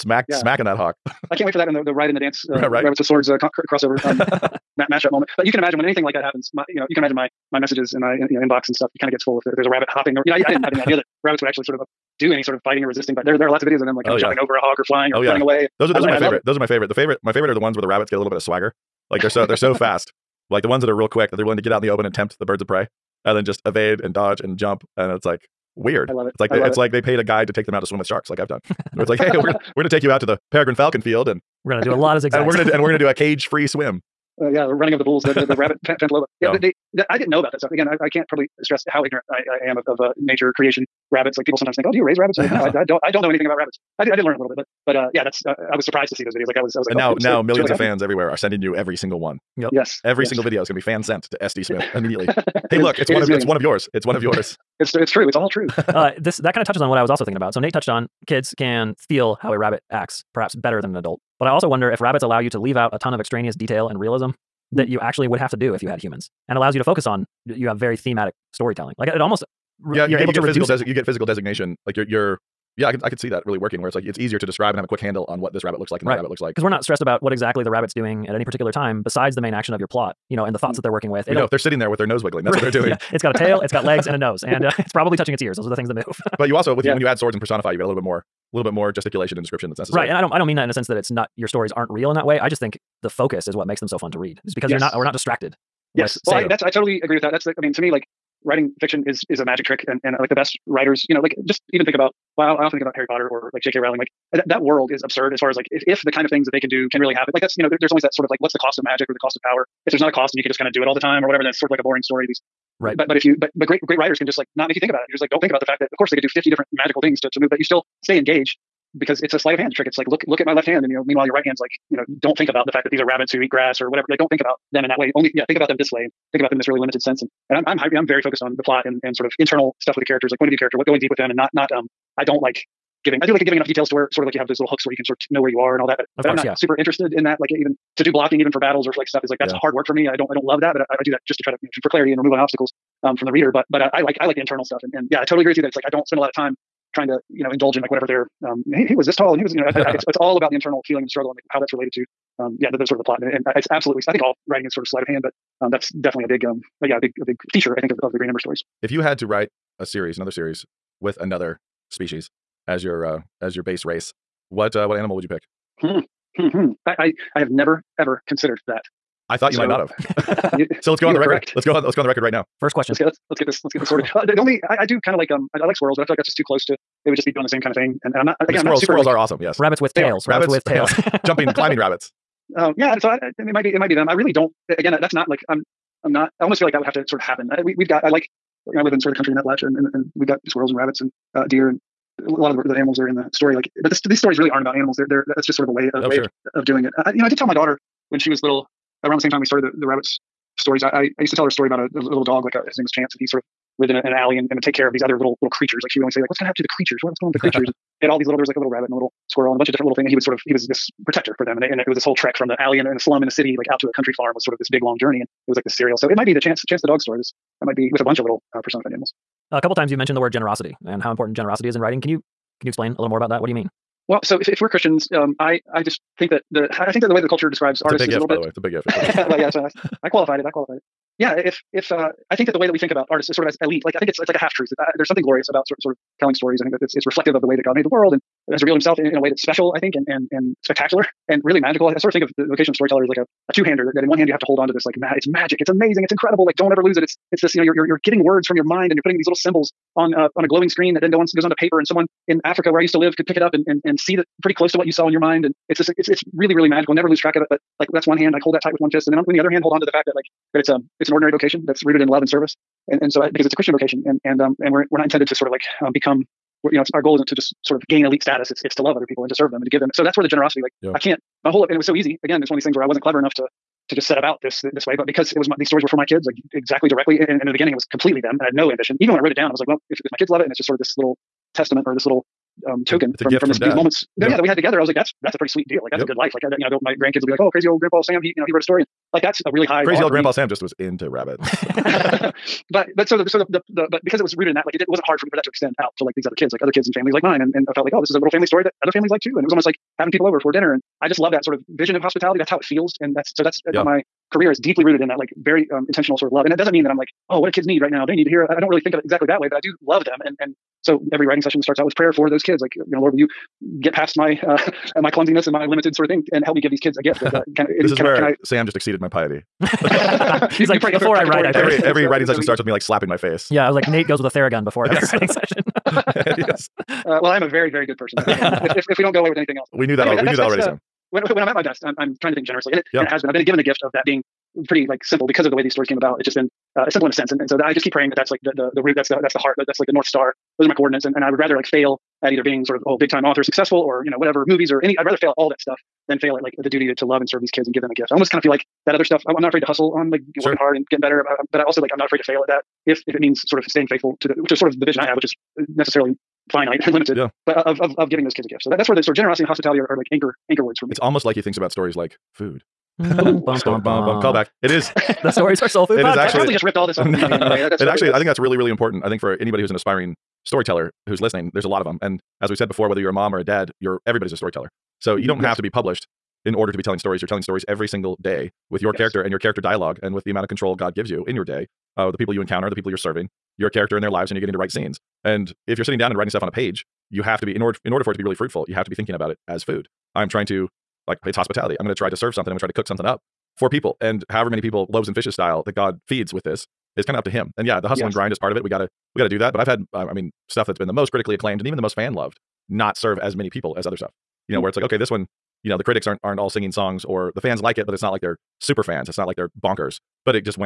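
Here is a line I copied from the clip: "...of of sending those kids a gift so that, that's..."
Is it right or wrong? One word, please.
wrong.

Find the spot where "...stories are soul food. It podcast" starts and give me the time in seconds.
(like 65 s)
365 s.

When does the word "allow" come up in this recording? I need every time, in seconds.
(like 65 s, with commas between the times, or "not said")
62 s, 66 s.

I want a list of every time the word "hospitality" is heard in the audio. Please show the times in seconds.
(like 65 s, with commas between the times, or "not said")
301 s, 359 s, 391 s.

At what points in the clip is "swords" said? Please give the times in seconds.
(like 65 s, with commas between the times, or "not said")
3 s, 87 s.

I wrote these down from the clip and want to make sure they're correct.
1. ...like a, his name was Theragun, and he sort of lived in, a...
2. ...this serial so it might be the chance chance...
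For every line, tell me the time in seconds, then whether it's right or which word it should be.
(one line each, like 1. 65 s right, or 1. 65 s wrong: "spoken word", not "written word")
1. 202 s wrong: "Chance", not "Theragun"
2. 215 s right.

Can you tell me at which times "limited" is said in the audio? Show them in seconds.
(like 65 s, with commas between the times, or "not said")
126 s, 315 s, 356 s.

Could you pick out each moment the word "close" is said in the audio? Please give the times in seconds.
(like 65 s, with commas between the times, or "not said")
176 s, 254 s.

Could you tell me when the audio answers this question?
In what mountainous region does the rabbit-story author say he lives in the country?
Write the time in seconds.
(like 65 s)
189 s.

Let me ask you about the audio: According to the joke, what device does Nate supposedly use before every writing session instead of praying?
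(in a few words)
Theragun.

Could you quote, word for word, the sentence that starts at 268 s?
It's it's to love other people and to serve them and to give them.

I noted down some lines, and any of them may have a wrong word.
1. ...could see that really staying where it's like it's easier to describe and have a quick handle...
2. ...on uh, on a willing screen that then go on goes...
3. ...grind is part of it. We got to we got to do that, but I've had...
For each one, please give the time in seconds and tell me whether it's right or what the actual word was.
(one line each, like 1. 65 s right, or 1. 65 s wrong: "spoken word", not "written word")
1. 73 s wrong: "working", not "staying"
2. 249 s wrong: "glowing", not "willing"
3. 398 s right.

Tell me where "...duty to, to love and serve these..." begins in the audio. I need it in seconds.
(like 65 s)
346 s.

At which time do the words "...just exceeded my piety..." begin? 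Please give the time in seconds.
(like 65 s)
318 s.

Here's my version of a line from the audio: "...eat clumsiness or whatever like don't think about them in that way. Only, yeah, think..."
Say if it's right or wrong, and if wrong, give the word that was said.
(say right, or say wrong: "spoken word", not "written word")
wrong: "grass", not "clumsiness".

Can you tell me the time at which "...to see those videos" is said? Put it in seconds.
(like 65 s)
46 s.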